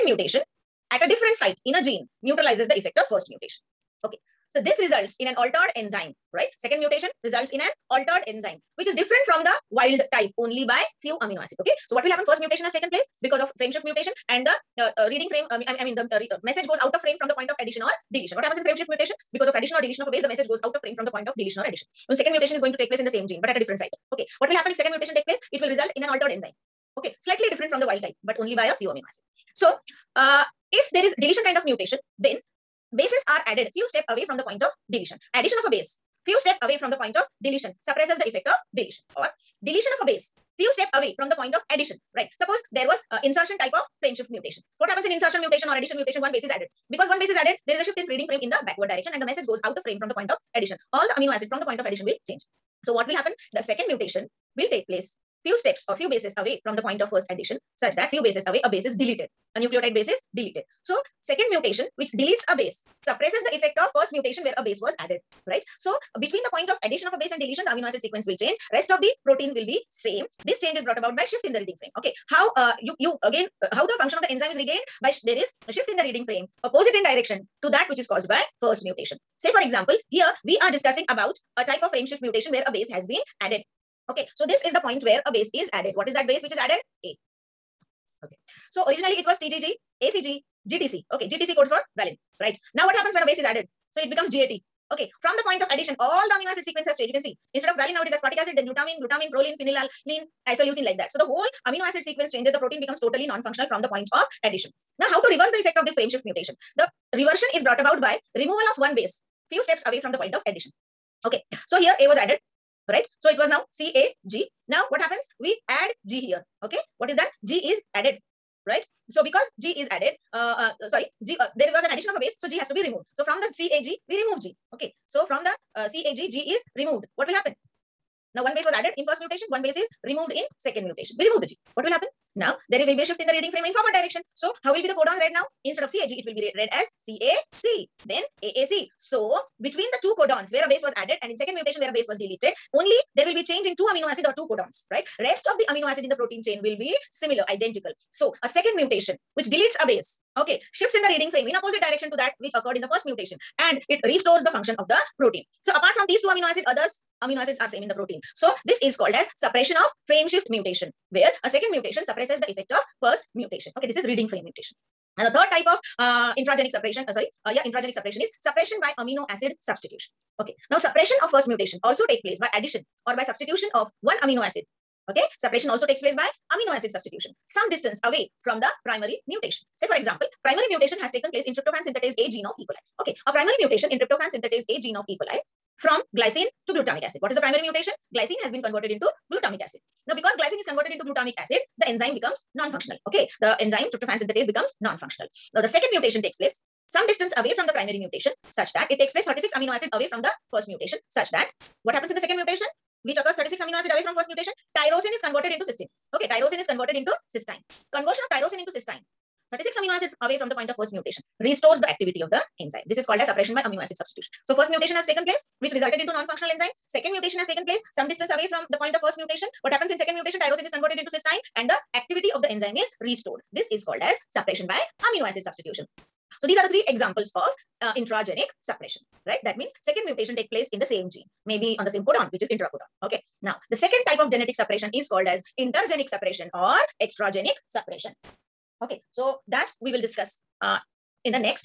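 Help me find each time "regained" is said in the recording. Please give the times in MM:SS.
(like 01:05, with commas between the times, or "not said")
01:14.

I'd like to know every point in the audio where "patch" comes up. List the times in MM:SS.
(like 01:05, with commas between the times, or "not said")
not said.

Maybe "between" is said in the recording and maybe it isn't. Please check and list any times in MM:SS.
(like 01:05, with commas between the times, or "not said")
01:06, 02:19.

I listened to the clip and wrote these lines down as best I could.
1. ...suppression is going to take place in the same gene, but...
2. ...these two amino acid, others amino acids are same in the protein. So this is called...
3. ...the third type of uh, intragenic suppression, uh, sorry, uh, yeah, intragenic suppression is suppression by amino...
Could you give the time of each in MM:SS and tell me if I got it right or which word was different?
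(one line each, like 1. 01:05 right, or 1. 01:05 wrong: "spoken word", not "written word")
1. 00:22 wrong: "mutation", not "suppression"
2. 02:36 right
3. 02:45 right.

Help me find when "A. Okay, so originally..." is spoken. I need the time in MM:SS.
01:27.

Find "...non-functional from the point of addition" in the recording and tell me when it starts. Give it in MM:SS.
01:43.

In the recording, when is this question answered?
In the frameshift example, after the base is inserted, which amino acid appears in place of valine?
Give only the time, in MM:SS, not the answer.
01:38.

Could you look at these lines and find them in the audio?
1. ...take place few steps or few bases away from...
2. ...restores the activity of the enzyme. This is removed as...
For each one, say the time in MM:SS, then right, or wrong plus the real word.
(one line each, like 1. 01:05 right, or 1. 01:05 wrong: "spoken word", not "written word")
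1. 00:54 right
2. 03:31 wrong: "called", not "removed".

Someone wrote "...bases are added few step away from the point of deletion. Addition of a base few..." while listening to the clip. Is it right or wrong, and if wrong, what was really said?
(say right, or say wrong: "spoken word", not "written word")
right.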